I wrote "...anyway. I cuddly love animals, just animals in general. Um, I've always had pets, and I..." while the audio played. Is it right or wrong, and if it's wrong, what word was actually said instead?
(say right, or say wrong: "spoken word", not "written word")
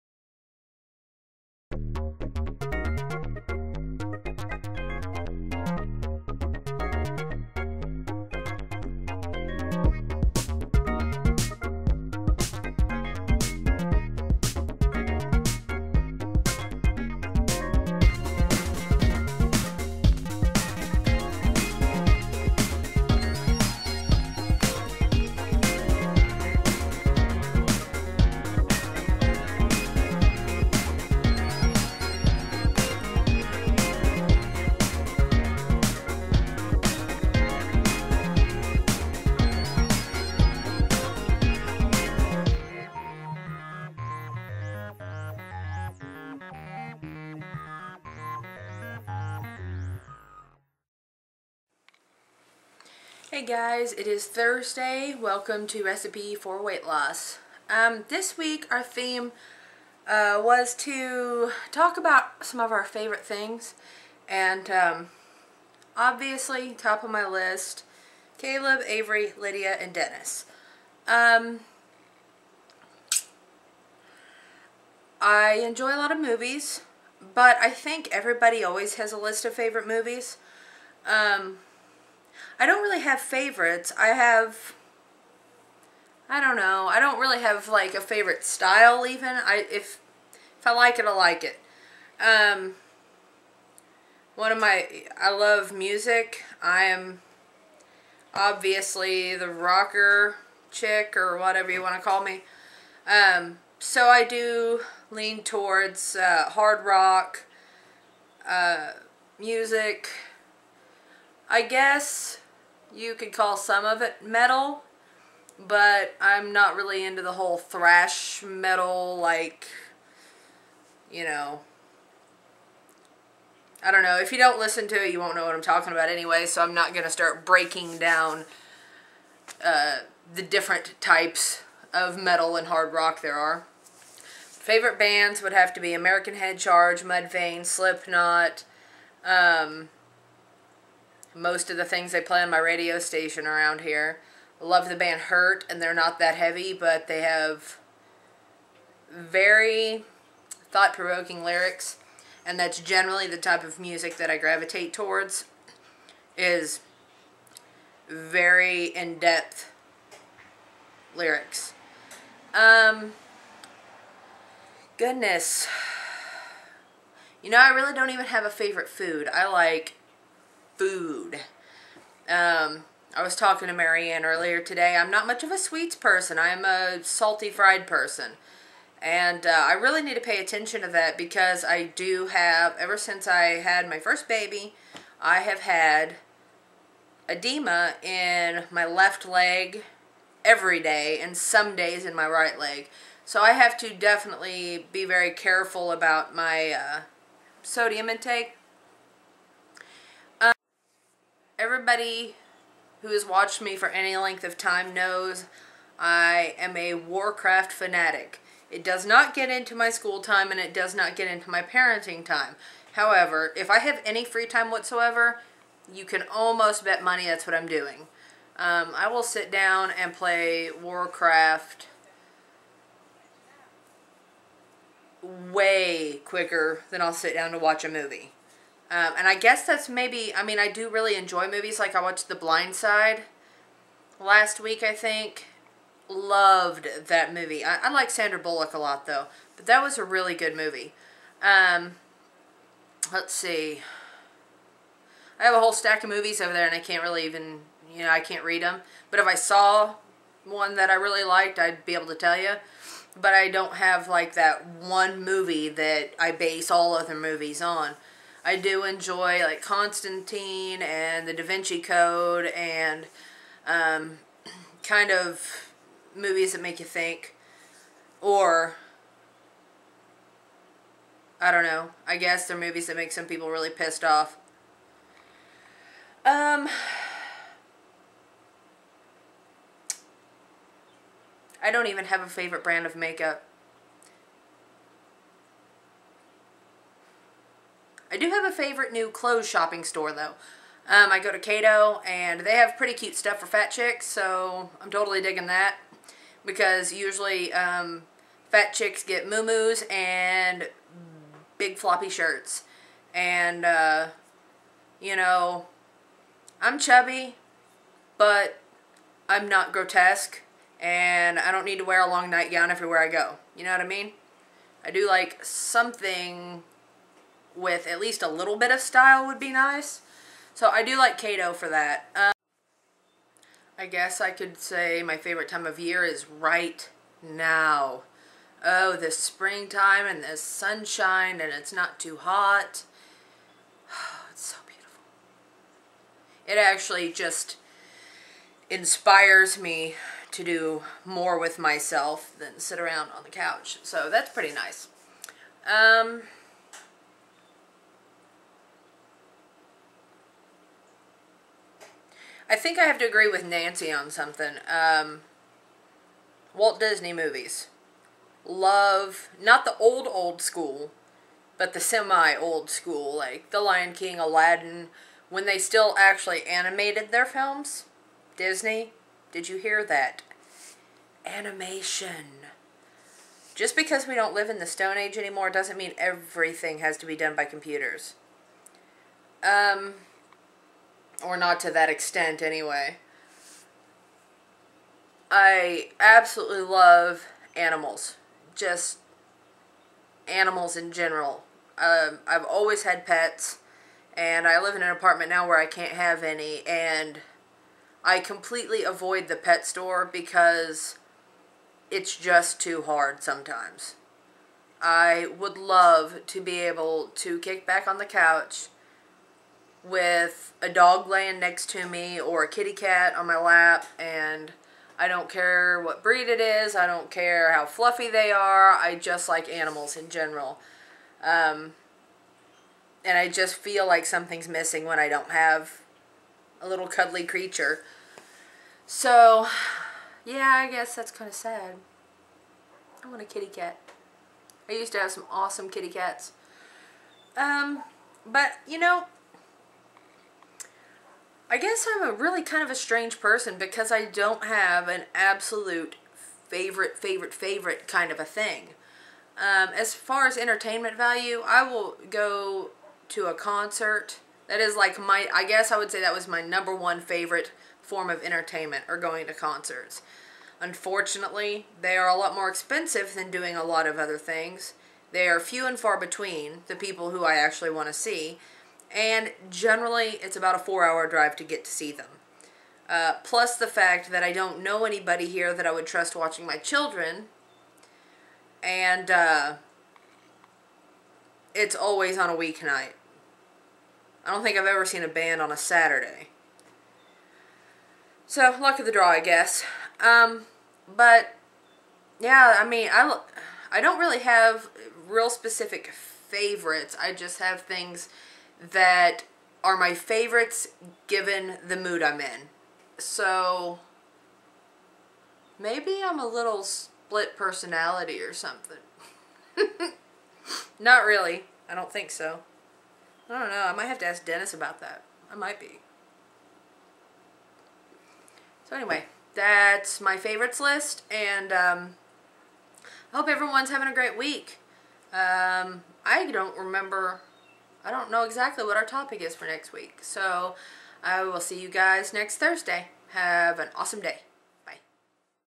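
wrong: "absolutely", not "cuddly".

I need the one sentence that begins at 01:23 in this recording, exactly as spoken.
I have, I don't know, I don't really have like a favorite style even.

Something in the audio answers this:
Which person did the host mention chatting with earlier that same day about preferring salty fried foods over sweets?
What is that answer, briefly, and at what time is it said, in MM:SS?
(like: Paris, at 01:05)
Marianne, at 02:53.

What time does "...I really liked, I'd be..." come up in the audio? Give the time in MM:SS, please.
04:10.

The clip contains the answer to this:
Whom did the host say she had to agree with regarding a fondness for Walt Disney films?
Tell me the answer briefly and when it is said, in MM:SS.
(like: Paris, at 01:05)
Nancy, at 05:53.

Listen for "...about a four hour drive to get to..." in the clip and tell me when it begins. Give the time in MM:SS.
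07:50.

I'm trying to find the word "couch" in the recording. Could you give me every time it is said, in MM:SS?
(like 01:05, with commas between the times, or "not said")
05:43, 06:48.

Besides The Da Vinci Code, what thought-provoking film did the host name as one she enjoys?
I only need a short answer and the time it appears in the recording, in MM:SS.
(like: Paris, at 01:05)
Constantine, at 04:19.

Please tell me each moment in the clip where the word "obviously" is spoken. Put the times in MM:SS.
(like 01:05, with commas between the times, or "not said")
01:05, 01:38.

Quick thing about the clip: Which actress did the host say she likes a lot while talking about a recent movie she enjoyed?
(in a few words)
Sandra Bullock.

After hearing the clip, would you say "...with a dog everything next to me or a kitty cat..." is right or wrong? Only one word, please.
wrong.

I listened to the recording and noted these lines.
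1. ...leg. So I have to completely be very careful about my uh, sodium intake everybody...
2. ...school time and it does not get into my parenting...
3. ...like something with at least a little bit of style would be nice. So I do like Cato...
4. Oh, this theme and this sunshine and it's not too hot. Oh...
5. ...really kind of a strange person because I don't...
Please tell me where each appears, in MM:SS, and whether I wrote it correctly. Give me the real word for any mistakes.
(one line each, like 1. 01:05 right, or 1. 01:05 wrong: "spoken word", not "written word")
1. 03:12 wrong: "definitely", not "completely"
2. 03:29 right
3. 05:15 right
4. 05:28 wrong: "springtime", not "theme"
5. 07:22 right.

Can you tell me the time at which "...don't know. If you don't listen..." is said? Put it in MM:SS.
02:03.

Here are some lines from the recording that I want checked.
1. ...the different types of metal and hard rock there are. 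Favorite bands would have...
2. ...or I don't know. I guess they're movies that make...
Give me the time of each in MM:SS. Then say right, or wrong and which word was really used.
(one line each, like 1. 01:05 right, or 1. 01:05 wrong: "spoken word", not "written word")
1. 02:10 right
2. 04:28 right.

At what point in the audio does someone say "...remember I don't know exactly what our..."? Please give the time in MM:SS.
08:46.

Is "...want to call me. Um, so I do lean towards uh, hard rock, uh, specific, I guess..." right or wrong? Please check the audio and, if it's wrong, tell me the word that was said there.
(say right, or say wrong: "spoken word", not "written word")
wrong: "music", not "specific".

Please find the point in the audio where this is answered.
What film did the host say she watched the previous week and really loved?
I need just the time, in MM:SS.
03:52.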